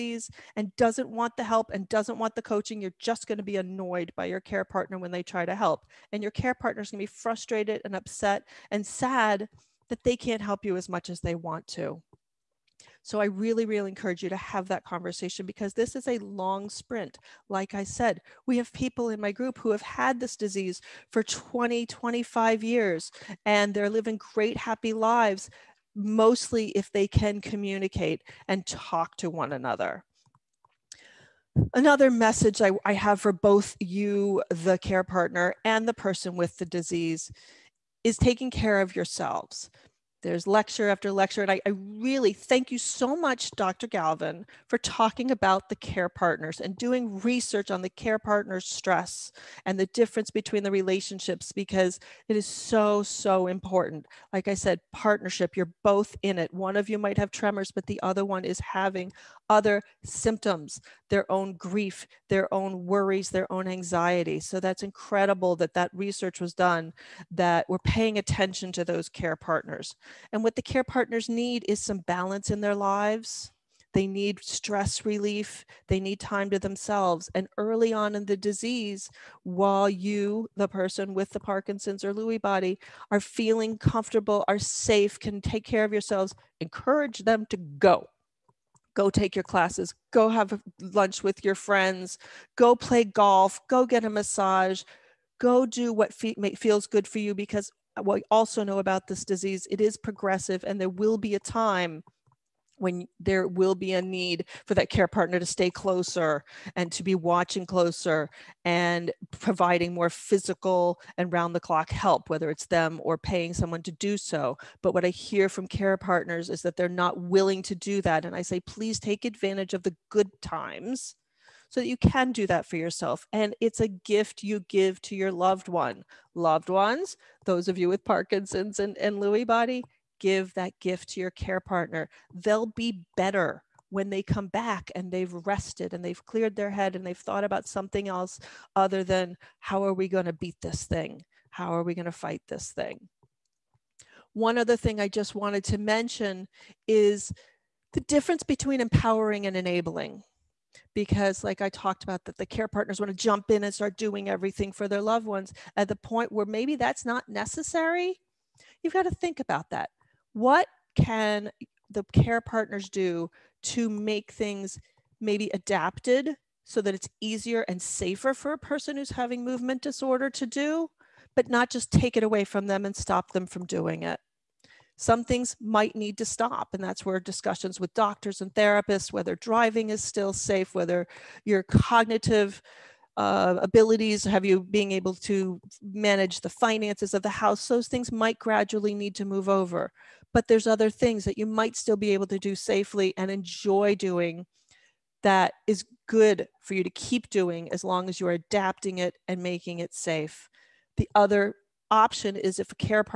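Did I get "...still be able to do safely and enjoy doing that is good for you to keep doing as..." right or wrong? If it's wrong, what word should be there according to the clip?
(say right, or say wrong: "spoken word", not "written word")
right.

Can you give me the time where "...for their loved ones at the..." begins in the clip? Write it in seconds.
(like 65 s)
154 s.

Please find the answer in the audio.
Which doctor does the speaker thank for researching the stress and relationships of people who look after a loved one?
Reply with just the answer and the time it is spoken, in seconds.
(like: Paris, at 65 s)
Dr. Galvin, at 43 s.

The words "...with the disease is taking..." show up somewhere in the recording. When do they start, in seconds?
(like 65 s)
36 s.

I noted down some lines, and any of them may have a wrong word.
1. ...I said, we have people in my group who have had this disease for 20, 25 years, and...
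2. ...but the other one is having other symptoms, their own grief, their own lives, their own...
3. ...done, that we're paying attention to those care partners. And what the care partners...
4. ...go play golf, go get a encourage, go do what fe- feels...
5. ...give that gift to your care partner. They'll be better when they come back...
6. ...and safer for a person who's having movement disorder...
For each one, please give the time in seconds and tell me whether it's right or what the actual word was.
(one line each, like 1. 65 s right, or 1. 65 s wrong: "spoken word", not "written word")
1. 17 s right
2. 57 s wrong: "worries", not "lives"
3. 66 s right
4. 92 s wrong: "massage", not "encourage"
5. 130 s right
6. 167 s right.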